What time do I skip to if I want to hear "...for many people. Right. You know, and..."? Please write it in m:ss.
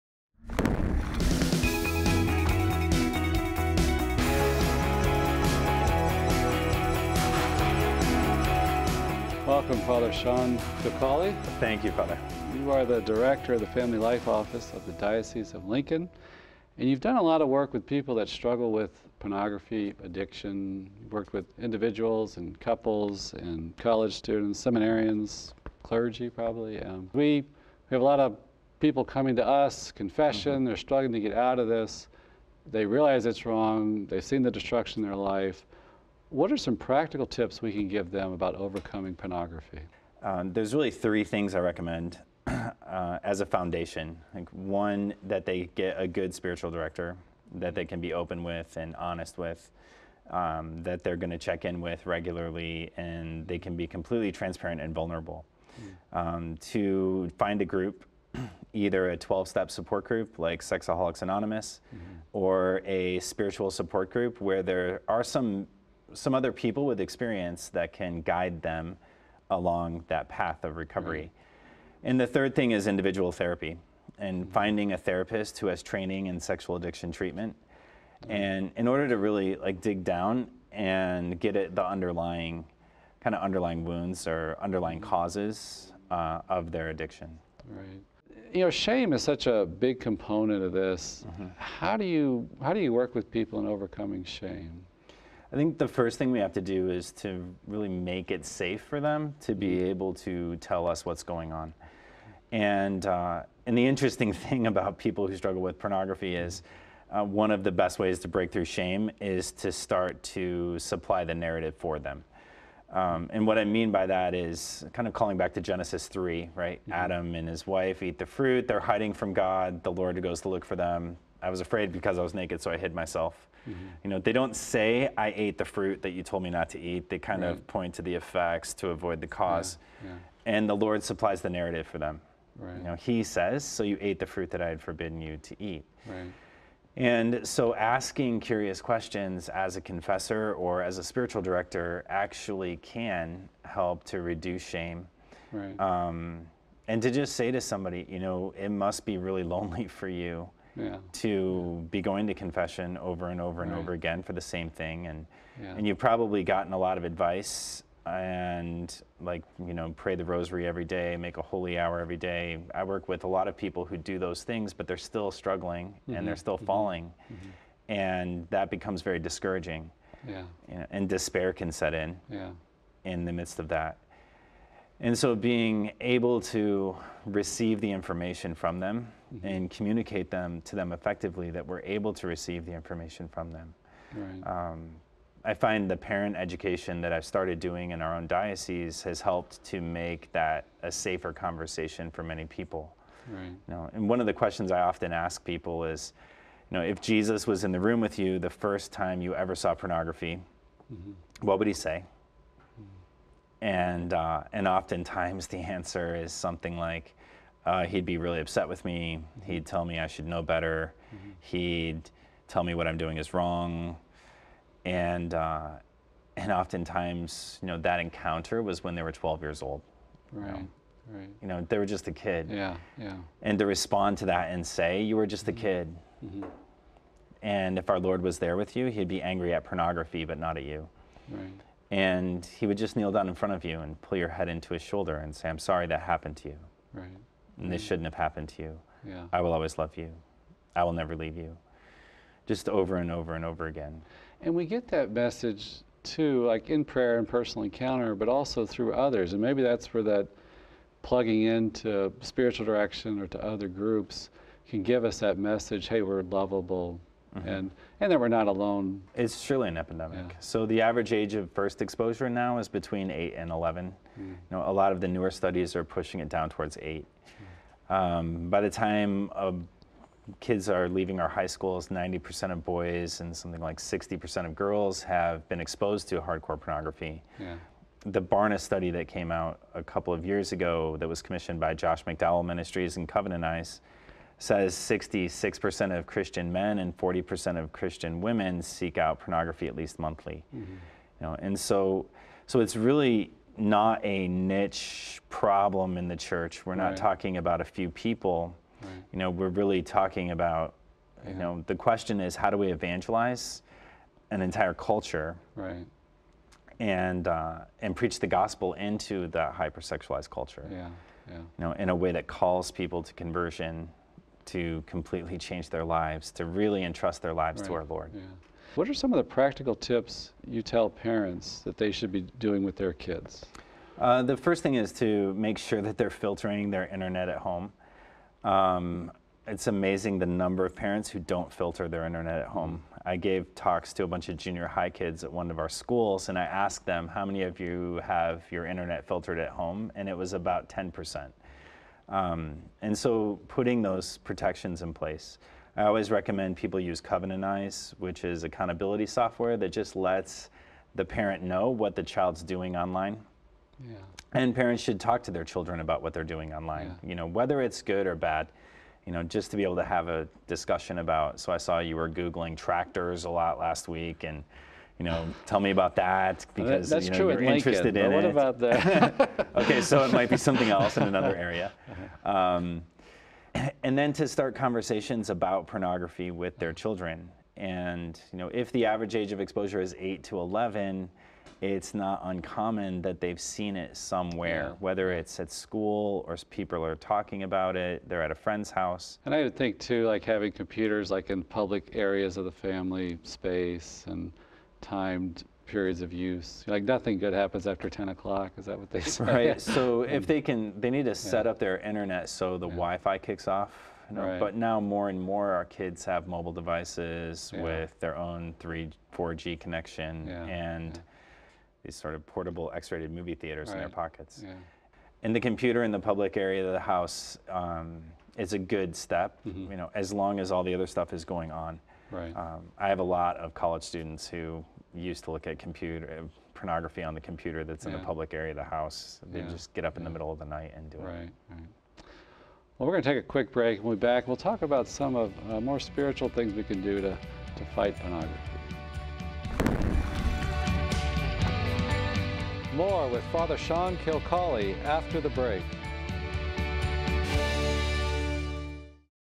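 3:12.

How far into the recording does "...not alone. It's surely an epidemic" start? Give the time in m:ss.
4:18.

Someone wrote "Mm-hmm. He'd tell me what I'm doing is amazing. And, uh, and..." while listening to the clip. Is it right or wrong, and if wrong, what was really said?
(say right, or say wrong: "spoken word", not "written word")
wrong: "wrong", not "amazing".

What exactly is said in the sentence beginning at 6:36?
Like nothing good happens after 10 o'clock.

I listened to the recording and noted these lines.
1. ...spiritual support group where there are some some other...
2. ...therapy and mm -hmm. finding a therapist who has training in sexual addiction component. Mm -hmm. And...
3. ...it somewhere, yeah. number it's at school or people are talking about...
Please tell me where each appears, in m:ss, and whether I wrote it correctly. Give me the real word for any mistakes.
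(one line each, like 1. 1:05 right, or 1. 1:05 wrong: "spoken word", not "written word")
1. 1:03 right
2. 1:13 wrong: "treatment", not "component"
3. 6:23 wrong: "whether", not "number".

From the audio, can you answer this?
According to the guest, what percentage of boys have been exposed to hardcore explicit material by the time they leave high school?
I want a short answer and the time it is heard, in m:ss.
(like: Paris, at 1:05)
90%, at 4:31.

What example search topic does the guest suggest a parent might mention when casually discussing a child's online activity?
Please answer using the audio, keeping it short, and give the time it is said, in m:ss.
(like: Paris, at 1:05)
tractors, at 6:02.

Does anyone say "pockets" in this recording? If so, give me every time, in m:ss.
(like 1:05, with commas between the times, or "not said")
6:53.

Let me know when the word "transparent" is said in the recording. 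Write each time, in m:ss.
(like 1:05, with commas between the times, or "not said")
0:54.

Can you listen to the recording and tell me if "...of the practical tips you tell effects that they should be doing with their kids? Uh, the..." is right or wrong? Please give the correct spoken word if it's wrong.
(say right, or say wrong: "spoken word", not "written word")
wrong: "parents", not "effects".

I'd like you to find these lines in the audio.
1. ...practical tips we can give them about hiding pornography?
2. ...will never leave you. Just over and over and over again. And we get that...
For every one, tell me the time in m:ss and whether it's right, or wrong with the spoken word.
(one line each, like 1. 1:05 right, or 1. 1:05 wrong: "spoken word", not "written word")
1. 0:36 wrong: "overcoming", not "hiding"
2. 4:00 right.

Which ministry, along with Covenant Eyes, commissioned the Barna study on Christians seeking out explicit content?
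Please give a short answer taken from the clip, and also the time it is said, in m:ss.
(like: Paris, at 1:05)
Josh McDowell Ministries, at 4:41.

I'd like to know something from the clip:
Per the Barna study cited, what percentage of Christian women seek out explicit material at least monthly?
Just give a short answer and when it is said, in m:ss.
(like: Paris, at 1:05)
40%, at 4:46.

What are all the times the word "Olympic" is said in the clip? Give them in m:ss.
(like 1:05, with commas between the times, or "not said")
not said.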